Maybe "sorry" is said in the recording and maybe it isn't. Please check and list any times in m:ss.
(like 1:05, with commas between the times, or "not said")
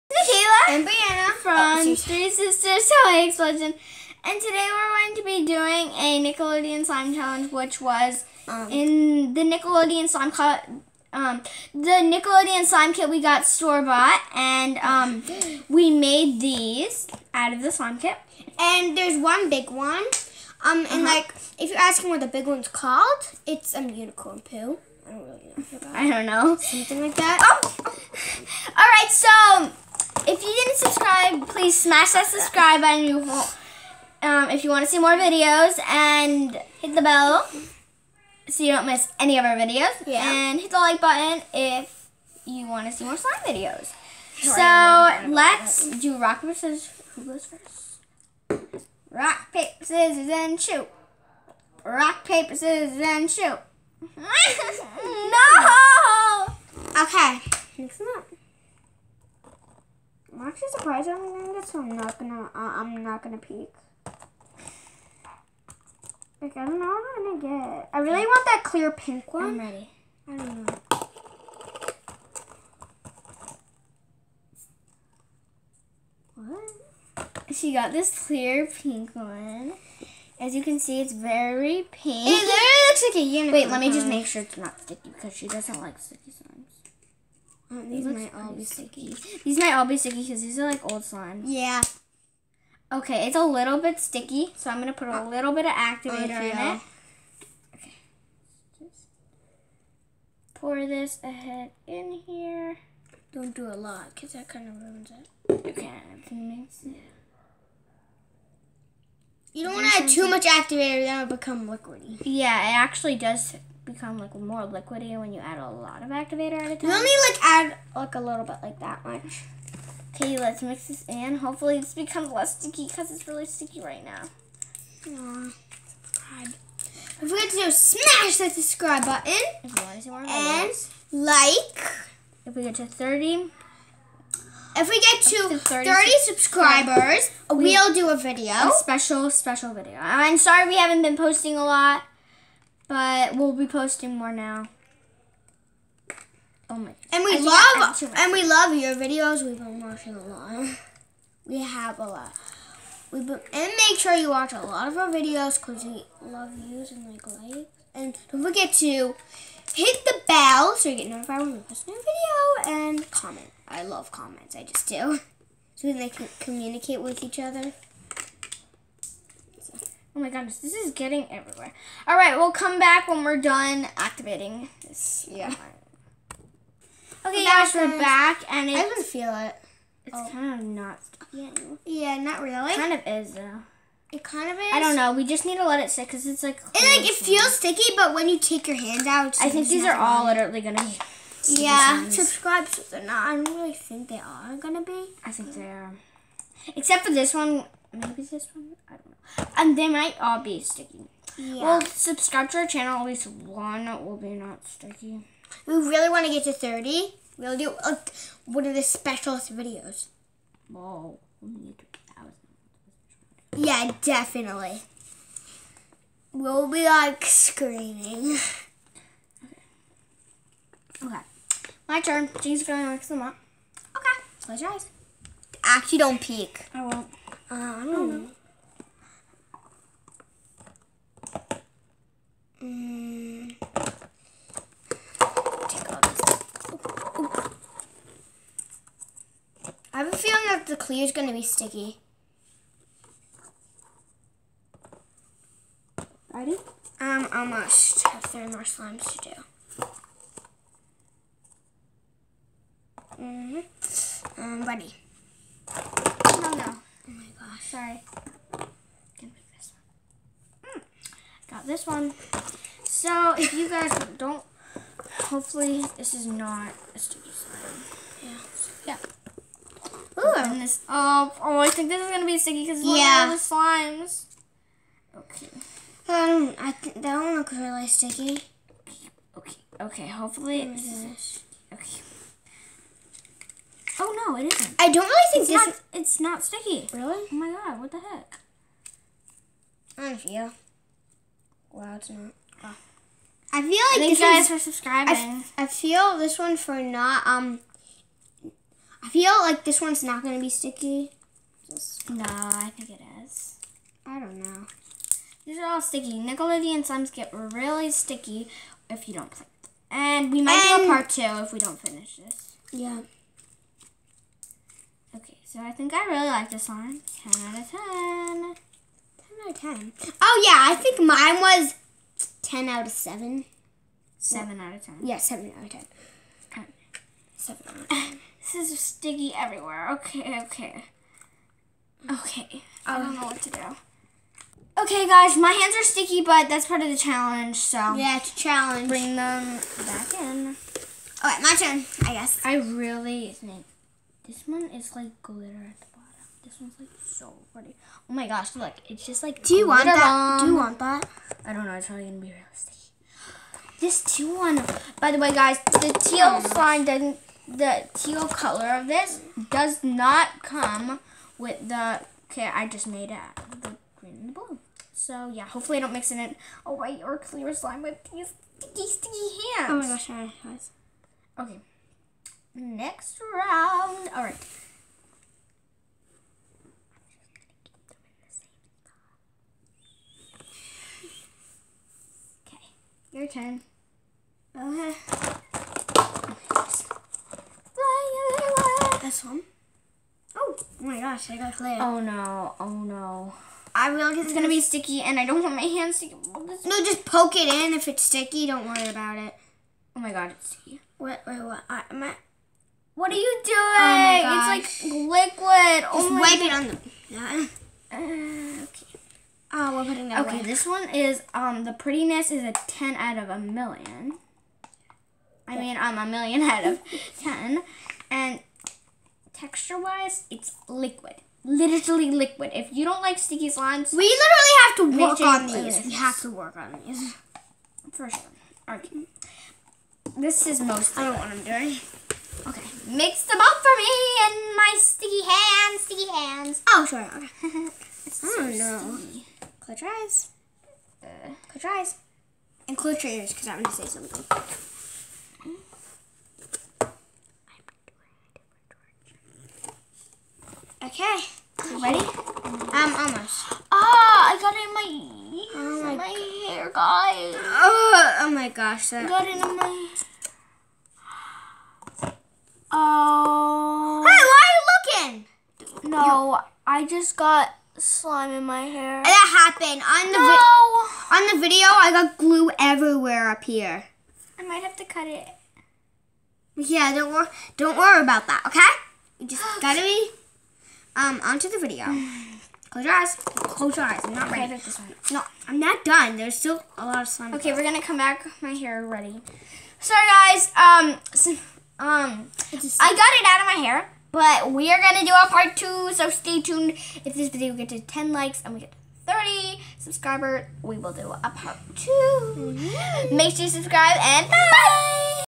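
2:20, 4:17, 8:09.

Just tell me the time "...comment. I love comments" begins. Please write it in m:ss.
2:43.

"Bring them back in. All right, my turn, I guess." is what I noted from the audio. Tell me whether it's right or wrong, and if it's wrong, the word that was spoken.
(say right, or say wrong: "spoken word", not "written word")
right.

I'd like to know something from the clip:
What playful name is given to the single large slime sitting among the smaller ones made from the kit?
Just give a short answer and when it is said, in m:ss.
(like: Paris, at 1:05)
unicorn poo, at 0:24.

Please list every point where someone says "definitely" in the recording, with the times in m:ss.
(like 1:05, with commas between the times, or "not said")
3:34.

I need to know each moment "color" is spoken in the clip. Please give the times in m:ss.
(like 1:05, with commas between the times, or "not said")
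5:58.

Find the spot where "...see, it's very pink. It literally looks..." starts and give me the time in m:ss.
1:20.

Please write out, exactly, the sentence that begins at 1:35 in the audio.
little bit of oh, activator oh, yeah.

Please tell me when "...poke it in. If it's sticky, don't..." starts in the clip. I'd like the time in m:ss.
6:37.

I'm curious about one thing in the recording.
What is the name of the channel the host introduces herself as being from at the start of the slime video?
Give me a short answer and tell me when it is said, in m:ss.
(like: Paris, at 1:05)
Three Sisters Toy Explosion, at 0:01.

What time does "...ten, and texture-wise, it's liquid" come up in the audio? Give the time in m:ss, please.
6:57.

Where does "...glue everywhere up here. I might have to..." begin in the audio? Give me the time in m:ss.
7:52.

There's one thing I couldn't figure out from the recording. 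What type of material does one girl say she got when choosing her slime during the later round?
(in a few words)
clay.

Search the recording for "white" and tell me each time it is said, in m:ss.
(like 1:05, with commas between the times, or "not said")
6:06.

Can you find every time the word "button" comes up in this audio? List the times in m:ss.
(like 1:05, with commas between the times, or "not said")
0:32, 0:41, 2:09.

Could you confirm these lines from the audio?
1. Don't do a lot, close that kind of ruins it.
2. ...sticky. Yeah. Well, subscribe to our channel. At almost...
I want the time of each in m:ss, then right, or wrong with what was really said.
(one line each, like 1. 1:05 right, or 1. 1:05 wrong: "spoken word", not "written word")
1. 1:43 wrong: "cause", not "close"
2. 3:20 wrong: "least", not "almost".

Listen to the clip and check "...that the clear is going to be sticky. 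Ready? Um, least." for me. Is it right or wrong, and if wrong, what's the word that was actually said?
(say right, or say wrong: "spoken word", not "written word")
wrong: "almost", not "least".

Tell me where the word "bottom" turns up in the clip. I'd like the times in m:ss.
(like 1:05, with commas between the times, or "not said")
5:45.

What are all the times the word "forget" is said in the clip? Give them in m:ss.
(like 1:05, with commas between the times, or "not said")
2:07, 2:38.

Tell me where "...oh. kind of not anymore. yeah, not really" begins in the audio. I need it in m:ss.
3:00.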